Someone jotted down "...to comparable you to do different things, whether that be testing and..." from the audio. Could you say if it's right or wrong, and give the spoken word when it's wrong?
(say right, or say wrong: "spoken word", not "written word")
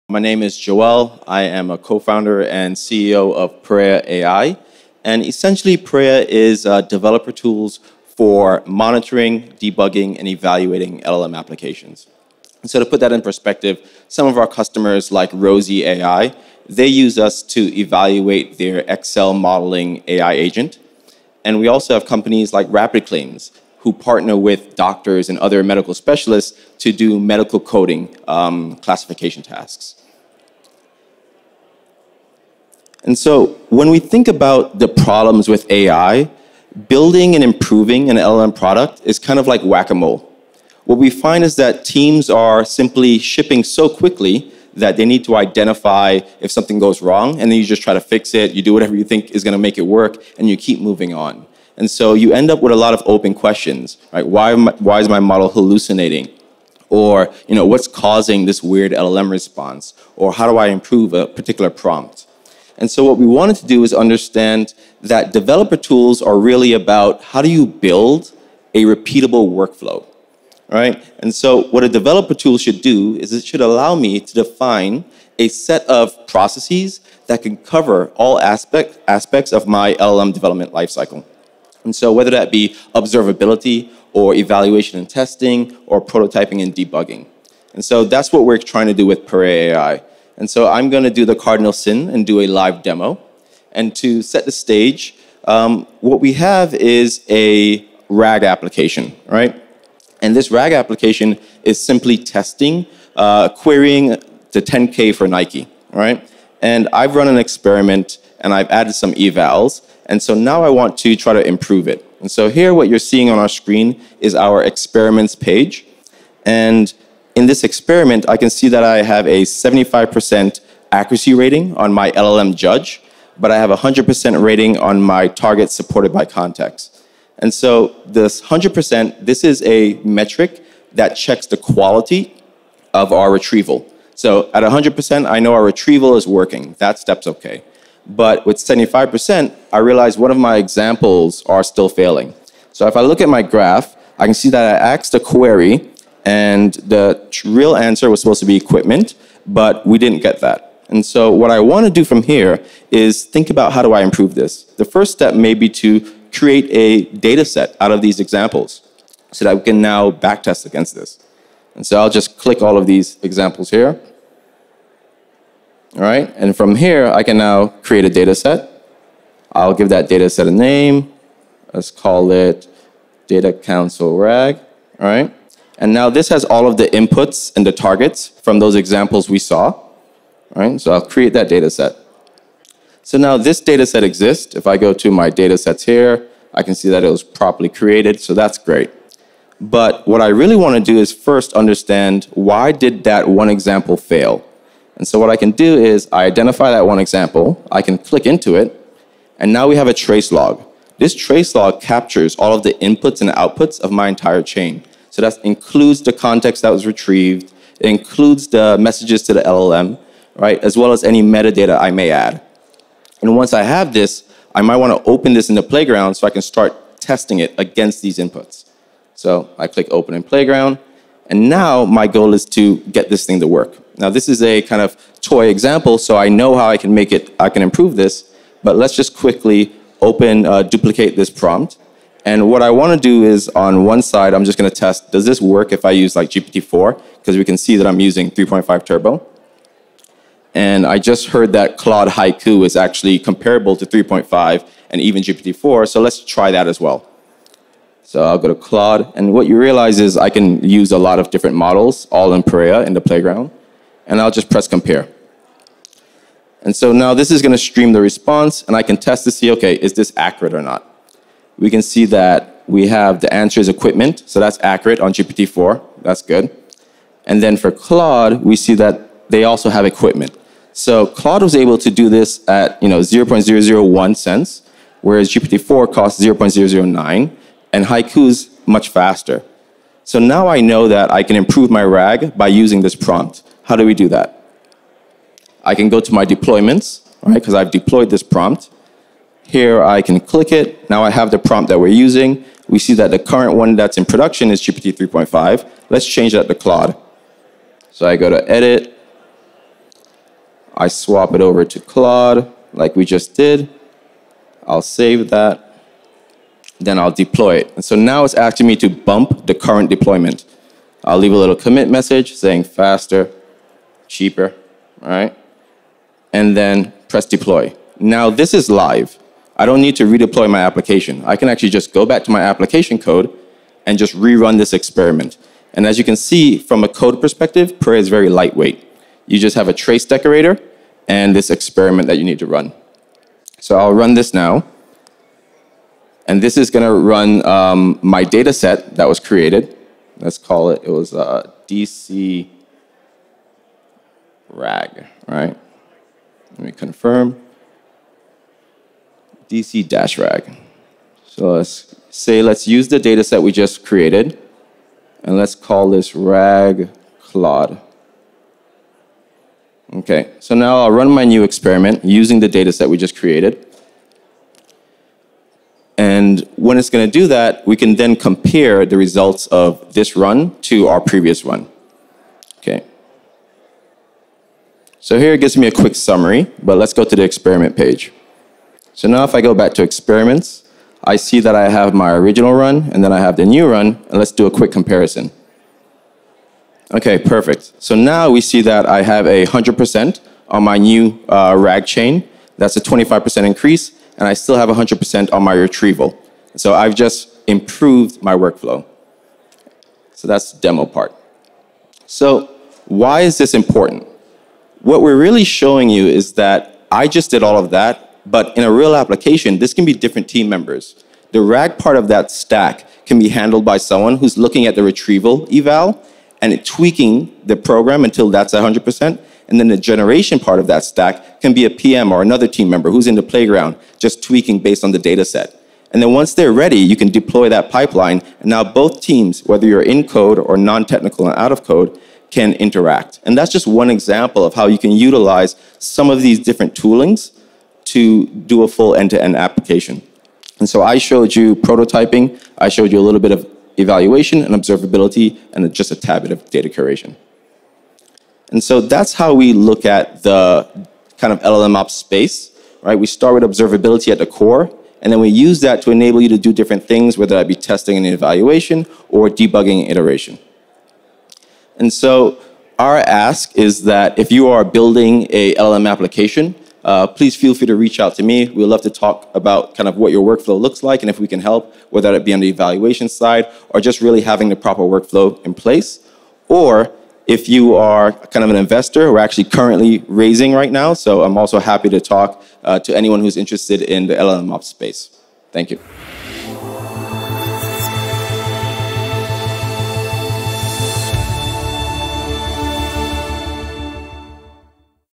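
wrong: "enable", not "comparable".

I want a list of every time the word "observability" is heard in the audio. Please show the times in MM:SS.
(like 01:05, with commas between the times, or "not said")
01:22, 07:24, 07:33.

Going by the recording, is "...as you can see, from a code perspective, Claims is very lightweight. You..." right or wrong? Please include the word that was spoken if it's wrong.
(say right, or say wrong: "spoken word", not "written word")
wrong: "Parea", not "Claims".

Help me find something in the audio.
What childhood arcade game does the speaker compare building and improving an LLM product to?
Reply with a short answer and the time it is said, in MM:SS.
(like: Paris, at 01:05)
Whack a mole, at 00:39.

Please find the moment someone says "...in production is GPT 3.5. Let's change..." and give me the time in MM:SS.
04:53.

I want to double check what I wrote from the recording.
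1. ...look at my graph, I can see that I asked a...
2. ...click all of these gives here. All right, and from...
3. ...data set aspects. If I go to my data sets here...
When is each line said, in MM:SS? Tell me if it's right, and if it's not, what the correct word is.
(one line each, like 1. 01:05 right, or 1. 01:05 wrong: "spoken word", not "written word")
1. 02:23 right
2. 02:42 wrong: "examples", not "gives"
3. 03:03 wrong: "exists", not "aspects".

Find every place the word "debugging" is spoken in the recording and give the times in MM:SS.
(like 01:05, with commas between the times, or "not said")
00:09, 01:26, 07:39.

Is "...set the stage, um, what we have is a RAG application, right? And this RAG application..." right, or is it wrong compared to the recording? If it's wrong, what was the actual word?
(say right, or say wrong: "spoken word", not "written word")
right.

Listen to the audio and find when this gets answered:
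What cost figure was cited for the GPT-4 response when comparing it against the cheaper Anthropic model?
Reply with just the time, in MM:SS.
04:36.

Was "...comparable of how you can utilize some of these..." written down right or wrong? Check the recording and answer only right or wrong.
wrong.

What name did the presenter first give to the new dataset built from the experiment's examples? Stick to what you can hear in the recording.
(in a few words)
Data Council RAG.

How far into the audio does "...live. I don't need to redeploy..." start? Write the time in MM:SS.
05:18.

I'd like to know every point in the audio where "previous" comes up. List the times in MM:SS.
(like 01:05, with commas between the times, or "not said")
06:11.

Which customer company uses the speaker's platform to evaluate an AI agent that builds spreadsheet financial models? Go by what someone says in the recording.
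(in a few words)
Rosie AI.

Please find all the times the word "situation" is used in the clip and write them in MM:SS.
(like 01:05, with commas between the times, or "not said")
not said.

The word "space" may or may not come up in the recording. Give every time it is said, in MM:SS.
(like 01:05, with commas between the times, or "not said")
07:31, 08:04.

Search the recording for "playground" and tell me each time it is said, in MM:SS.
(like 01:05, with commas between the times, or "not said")
03:35, 03:40, 04:12, 07:03.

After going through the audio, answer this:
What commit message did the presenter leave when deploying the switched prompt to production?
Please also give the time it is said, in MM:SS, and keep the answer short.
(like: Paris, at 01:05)
Faster, cheaper, at 05:12.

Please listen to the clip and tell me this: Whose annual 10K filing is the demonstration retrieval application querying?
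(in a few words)
Nike.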